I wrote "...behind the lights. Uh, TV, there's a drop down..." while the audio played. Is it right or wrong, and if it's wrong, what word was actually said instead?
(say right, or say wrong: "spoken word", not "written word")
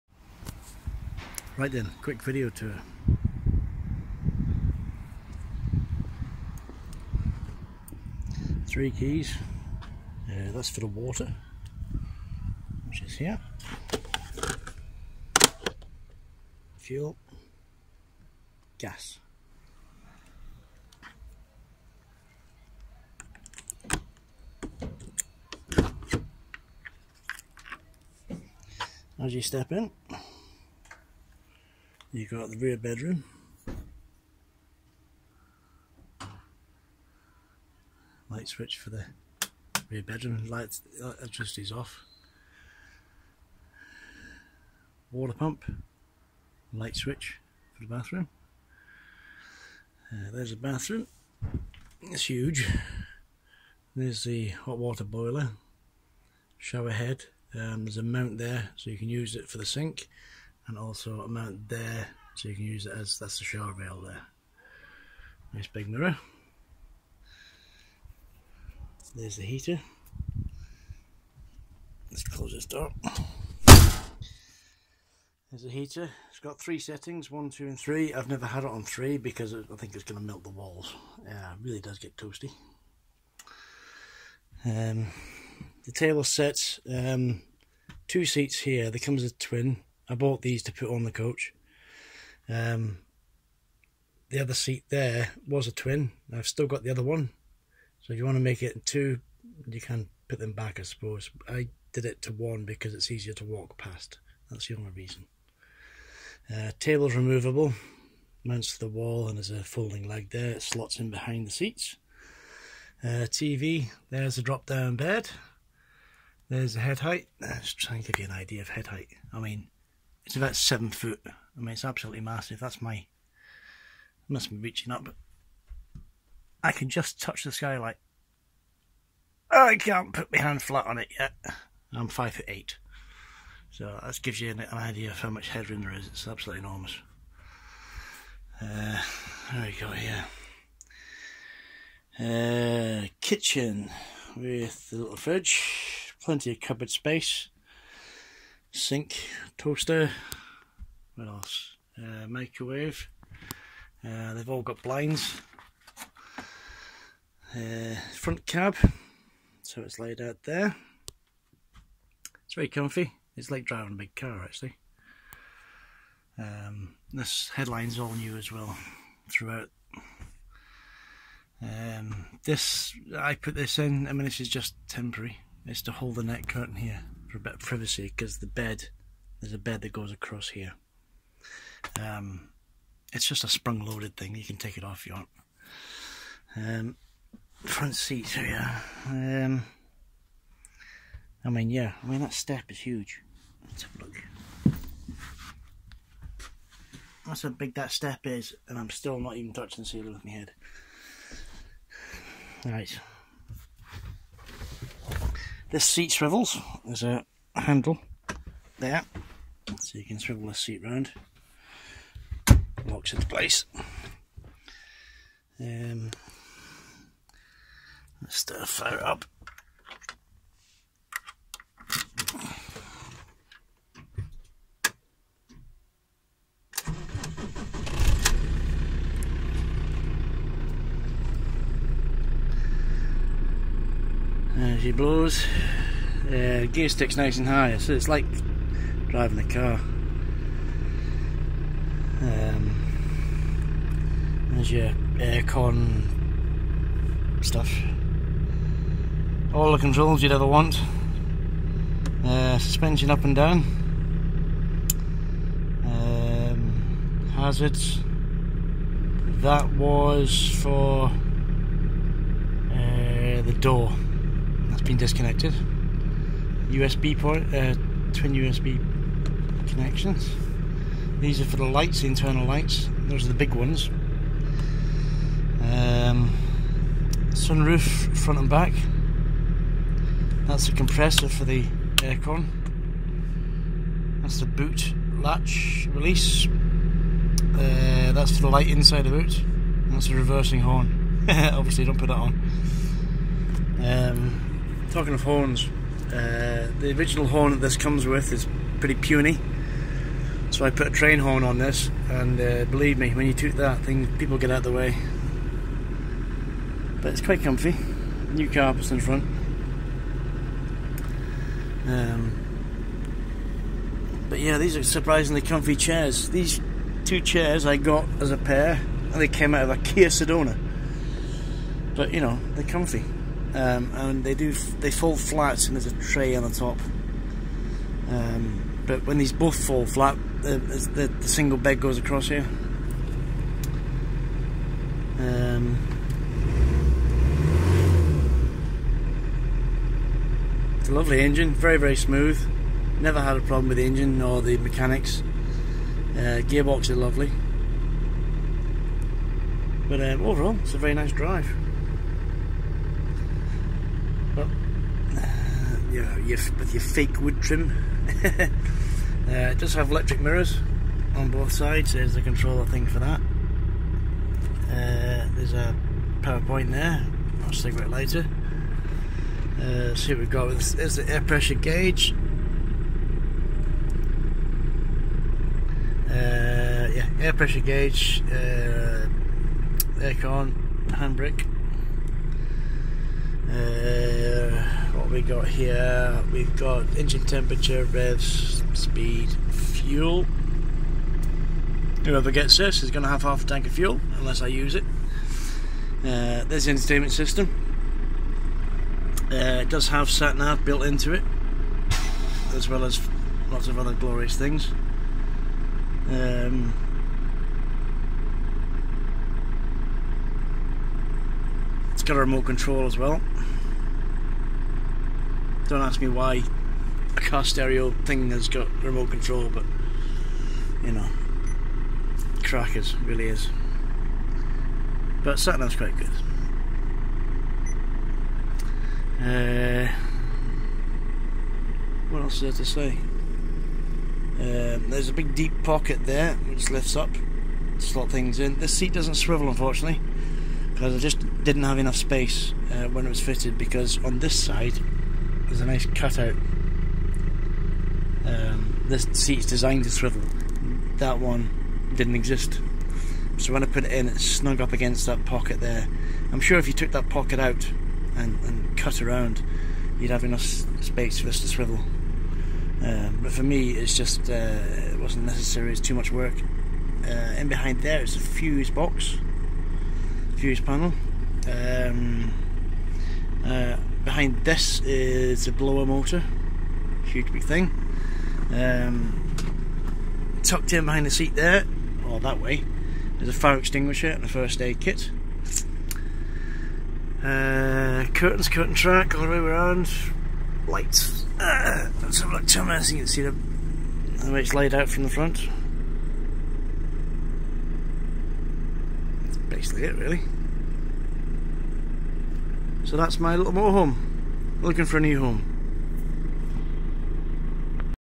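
wrong: "seats", not "lights".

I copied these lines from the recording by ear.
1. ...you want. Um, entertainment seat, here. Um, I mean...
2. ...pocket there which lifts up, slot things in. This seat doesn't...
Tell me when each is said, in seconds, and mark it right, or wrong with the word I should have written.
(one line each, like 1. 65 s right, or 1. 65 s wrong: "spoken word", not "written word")
1. 185 s wrong: "front", not "entertainment"
2. 435 s right.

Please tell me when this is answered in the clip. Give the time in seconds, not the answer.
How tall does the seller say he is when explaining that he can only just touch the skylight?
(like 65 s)
132 s.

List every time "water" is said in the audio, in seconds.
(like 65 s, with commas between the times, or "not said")
10 s, 45 s, 54 s.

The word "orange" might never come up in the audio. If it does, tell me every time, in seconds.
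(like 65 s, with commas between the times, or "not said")
not said.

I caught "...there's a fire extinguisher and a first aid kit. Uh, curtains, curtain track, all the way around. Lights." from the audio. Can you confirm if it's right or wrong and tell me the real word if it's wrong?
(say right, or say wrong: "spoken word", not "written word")
right.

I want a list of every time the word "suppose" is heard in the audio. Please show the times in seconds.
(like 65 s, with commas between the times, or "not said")
100 s.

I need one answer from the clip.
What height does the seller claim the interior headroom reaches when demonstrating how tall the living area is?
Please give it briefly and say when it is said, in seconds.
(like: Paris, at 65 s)
7 foot, at 120 s.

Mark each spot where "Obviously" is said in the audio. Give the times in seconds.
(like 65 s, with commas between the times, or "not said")
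291 s.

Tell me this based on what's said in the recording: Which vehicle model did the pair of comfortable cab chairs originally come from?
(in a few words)
Kia Sedona.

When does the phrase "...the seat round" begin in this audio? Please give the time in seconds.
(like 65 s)
210 s.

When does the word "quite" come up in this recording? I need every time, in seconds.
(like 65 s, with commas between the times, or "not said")
307 s, 425 s.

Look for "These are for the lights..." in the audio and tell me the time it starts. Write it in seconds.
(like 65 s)
271 s.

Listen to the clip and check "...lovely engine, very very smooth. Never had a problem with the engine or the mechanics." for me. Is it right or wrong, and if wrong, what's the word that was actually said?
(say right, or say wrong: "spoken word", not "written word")
right.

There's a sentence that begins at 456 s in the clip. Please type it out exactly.
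I'm sure if you took that pocket out and, and cut around, you'd have enough space for us to swivel.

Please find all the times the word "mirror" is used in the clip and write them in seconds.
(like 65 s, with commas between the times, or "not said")
65 s, 360 s.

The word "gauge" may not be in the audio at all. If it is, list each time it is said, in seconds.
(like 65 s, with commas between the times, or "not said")
371 s, 377 s.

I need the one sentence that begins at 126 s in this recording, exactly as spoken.
I can just touch the skylight.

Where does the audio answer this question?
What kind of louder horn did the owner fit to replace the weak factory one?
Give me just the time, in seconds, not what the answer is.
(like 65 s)
300 s.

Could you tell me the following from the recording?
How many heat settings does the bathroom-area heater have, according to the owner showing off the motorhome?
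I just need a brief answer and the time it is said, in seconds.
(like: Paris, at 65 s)
3, at 76 s.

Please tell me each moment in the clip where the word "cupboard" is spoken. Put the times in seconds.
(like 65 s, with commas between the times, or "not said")
146 s.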